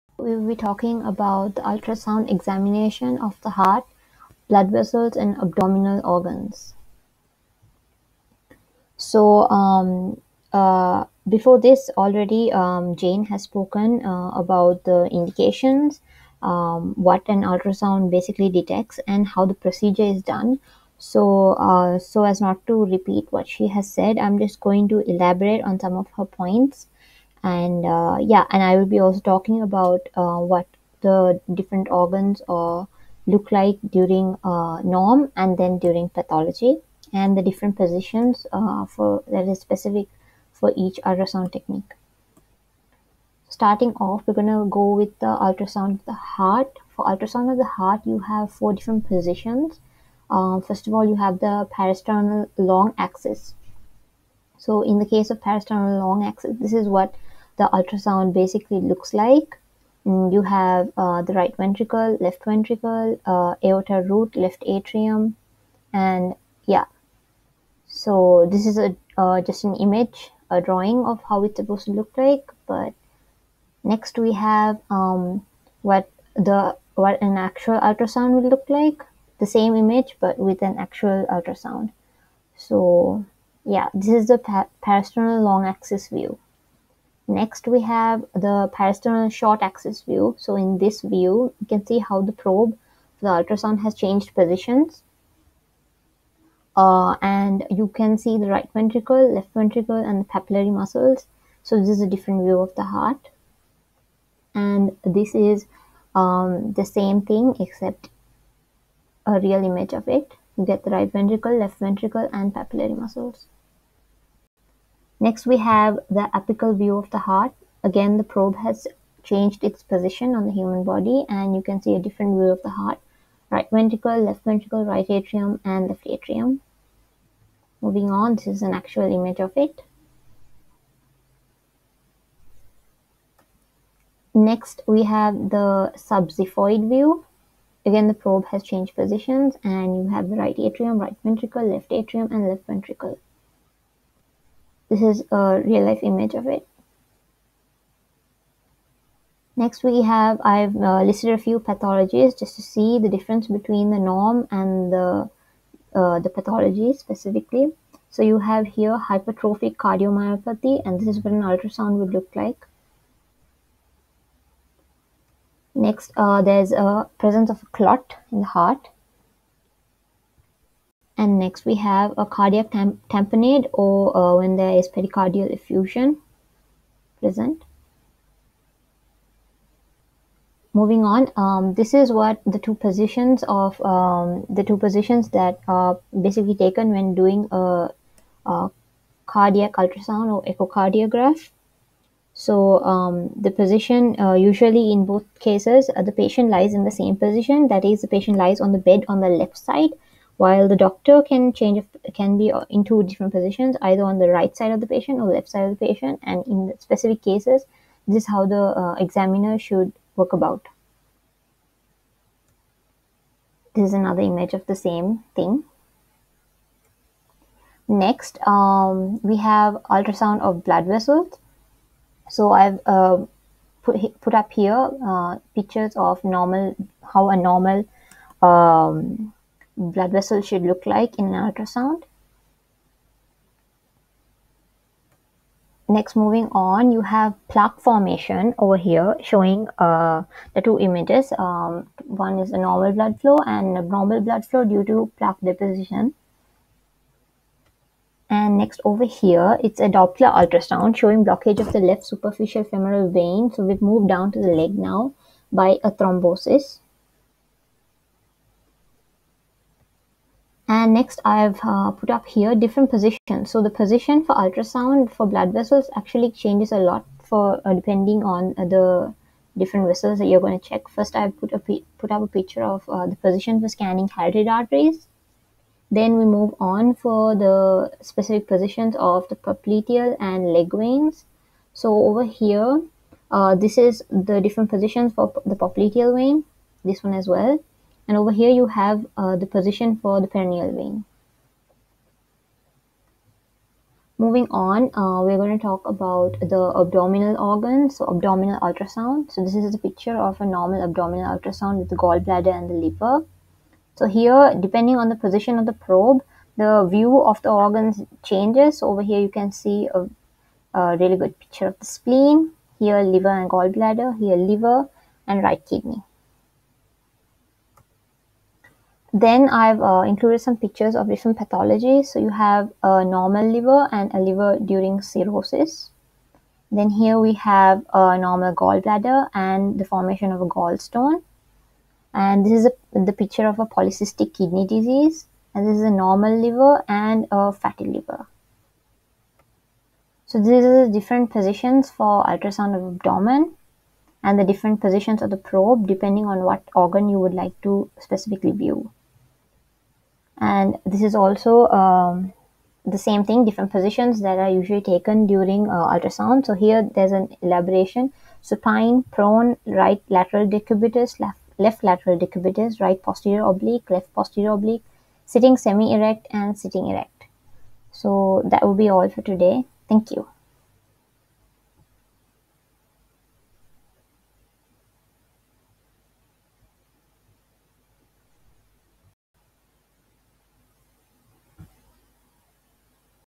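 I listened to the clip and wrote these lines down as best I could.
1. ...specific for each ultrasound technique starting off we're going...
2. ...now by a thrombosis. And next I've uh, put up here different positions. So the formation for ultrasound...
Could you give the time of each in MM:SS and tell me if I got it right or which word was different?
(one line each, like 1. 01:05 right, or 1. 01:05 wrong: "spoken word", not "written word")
1. 00:39 right
2. 04:14 wrong: "position", not "formation".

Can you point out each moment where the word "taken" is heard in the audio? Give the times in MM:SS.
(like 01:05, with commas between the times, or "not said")
03:06, 05:54.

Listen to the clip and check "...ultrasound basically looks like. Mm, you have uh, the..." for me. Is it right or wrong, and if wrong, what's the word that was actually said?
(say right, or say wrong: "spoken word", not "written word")
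right.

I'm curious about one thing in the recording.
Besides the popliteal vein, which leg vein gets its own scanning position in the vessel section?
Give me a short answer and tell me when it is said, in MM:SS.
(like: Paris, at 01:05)
Peroneal vein, at 04:50.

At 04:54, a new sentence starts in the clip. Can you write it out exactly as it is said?
Moving on, uh, we're going to talk about the abdominal organs, so abdominal ultrasound.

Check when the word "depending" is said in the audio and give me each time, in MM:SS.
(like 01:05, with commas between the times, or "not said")
04:27, 05:04, 05:45.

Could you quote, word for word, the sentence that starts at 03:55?
Next, moving on, you have plaque formation over here showing uh, the two images.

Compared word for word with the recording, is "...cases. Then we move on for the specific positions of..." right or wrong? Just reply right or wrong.
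wrong.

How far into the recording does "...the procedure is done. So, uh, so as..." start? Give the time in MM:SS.
00:19.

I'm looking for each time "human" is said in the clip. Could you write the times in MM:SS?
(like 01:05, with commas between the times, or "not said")
02:00.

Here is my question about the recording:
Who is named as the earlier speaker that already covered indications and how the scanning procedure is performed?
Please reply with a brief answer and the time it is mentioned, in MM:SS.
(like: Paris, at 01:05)
Jane, at 00:12.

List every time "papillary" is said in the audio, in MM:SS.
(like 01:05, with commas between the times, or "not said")
01:40, 01:52.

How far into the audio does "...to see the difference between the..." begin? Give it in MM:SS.
02:32.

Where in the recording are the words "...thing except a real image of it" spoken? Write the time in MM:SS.
01:47.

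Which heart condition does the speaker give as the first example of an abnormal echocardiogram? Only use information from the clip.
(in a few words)
Hypertrophic cardiomyopathy.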